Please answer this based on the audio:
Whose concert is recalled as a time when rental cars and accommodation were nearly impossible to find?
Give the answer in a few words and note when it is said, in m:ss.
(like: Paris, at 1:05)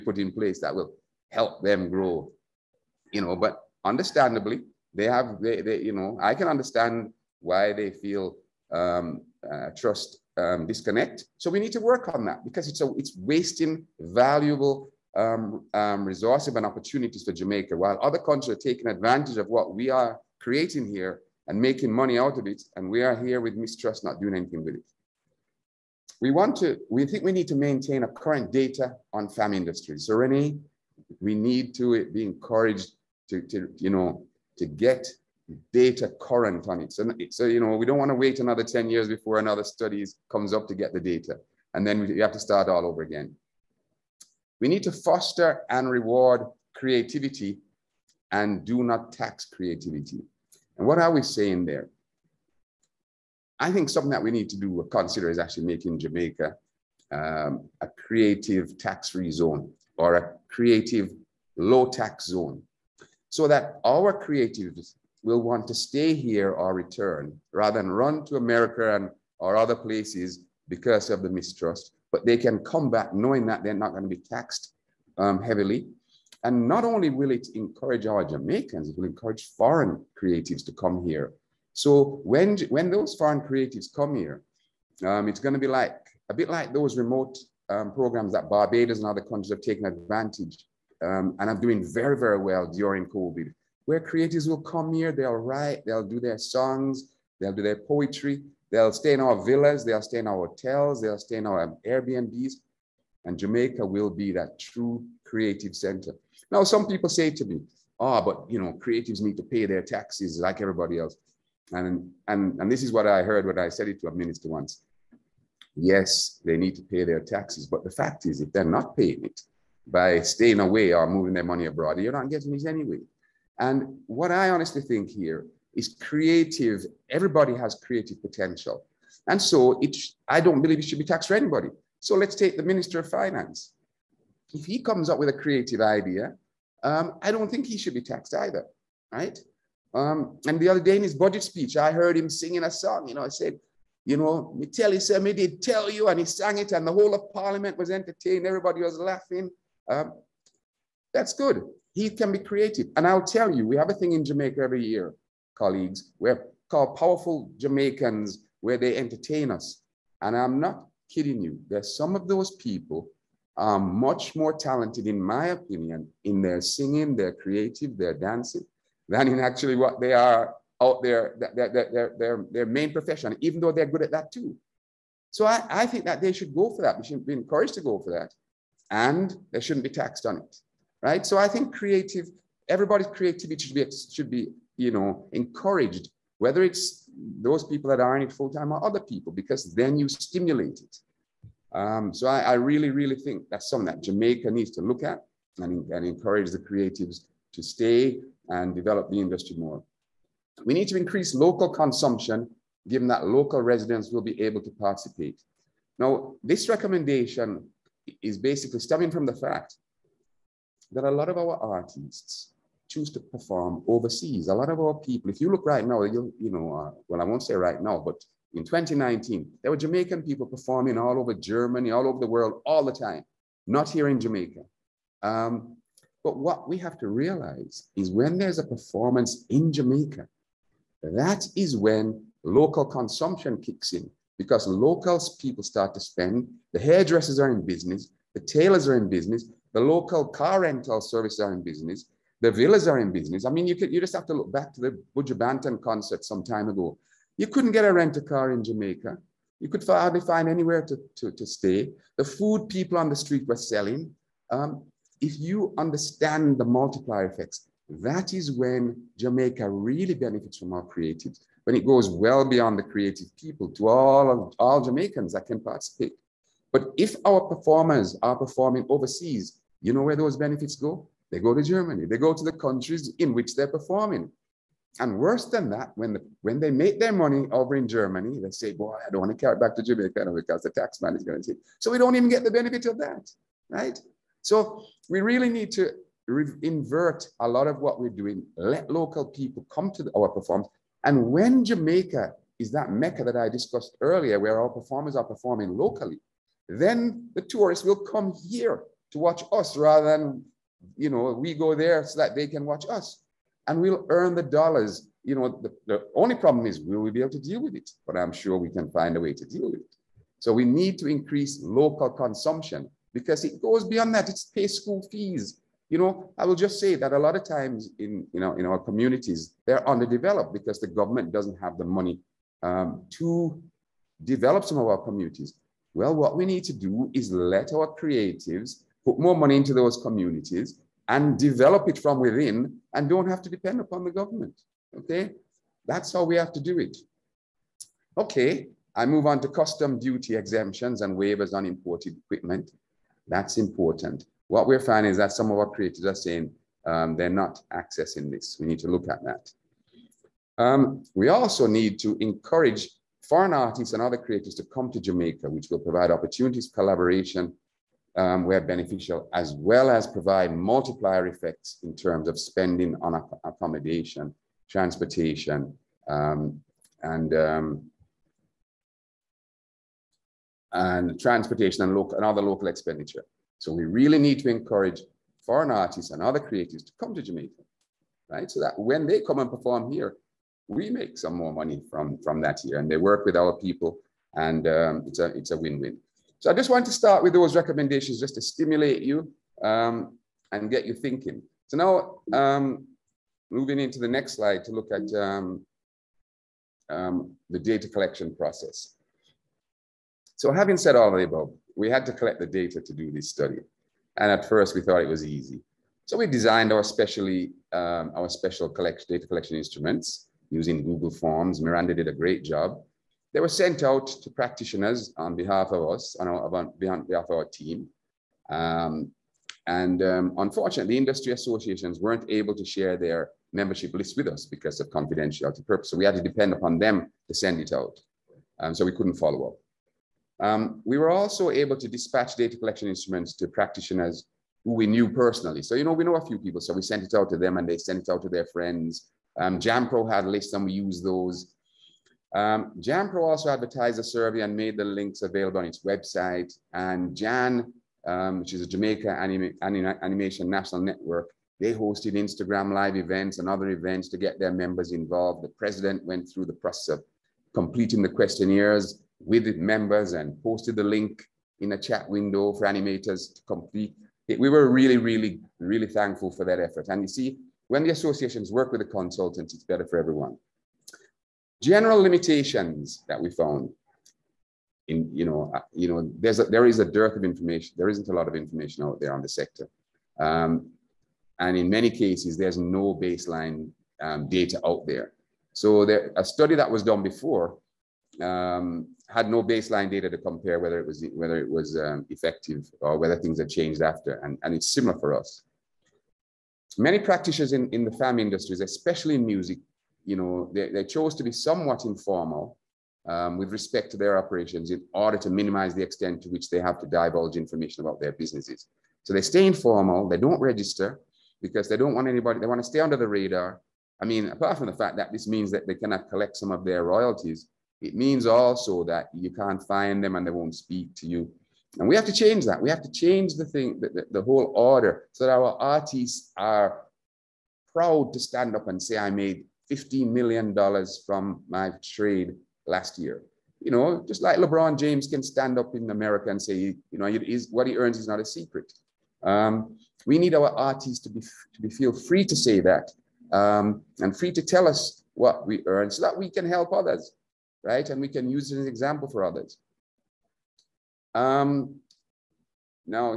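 Buju Banton, at 4:05.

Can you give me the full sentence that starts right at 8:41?
And we have to change that.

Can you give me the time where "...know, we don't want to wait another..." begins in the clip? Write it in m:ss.
0:37.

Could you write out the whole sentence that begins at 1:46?
Now, some people say to me, oh, but you know, creatives need to pay their taxes like everybody else.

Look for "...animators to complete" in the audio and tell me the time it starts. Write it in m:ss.
7:42.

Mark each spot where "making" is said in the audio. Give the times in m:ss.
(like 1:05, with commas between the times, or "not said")
0:21, 0:55.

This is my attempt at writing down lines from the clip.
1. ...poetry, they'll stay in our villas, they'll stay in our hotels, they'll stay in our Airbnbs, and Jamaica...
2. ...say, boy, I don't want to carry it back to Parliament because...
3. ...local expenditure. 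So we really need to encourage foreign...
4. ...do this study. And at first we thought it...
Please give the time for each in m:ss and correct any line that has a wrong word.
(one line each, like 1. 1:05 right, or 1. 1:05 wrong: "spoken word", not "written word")
1. 1:37 right
2. 4:38 wrong: "Jamaica", not "Parliament"
3. 6:12 right
4. 6:42 right.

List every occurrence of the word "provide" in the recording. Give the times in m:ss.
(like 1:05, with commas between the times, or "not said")
5:55, 6:00.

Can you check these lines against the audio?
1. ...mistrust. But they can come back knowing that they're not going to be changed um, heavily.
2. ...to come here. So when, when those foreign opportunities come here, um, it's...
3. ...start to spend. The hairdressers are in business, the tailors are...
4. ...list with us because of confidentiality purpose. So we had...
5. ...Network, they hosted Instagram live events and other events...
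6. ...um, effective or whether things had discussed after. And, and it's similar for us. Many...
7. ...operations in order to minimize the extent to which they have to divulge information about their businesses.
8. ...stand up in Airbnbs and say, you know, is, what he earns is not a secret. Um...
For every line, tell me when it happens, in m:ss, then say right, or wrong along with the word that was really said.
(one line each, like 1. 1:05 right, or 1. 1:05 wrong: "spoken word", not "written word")
1. 1:11 wrong: "taxed", not "changed"
2. 1:20 wrong: "creatives", not "opportunities"
3. 3:55 right
4. 7:03 right
5. 7:30 right
6. 8:11 wrong: "changed", not "discussed"
7. 8:24 right
8. 8:55 wrong: "America", not "Airbnbs".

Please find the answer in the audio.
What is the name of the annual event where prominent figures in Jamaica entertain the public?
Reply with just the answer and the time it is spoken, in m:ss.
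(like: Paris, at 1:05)
Powerful Jamaicans, at 2:36.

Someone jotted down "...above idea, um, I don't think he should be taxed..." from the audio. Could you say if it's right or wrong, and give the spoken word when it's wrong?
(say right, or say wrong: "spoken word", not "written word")
wrong: "creative", not "above".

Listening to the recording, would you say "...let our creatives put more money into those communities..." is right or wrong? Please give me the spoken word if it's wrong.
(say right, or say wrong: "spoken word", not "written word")
right.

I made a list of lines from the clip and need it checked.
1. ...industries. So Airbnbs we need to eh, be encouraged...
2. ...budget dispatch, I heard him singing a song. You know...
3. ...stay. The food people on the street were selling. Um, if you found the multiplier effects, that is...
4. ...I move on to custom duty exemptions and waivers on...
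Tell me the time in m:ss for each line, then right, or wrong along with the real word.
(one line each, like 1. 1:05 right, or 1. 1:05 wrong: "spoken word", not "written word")
1. 0:29 wrong: "Renee", not "Airbnbs"
2. 2:21 wrong: "speech", not "dispatch"
3. 4:11 wrong: "understand", not "found"
4. 5:38 right.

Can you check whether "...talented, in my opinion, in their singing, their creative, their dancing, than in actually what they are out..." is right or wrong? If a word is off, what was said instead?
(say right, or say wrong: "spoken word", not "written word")
right.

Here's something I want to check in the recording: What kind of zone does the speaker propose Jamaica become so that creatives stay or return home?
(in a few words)
creative tax-free zone.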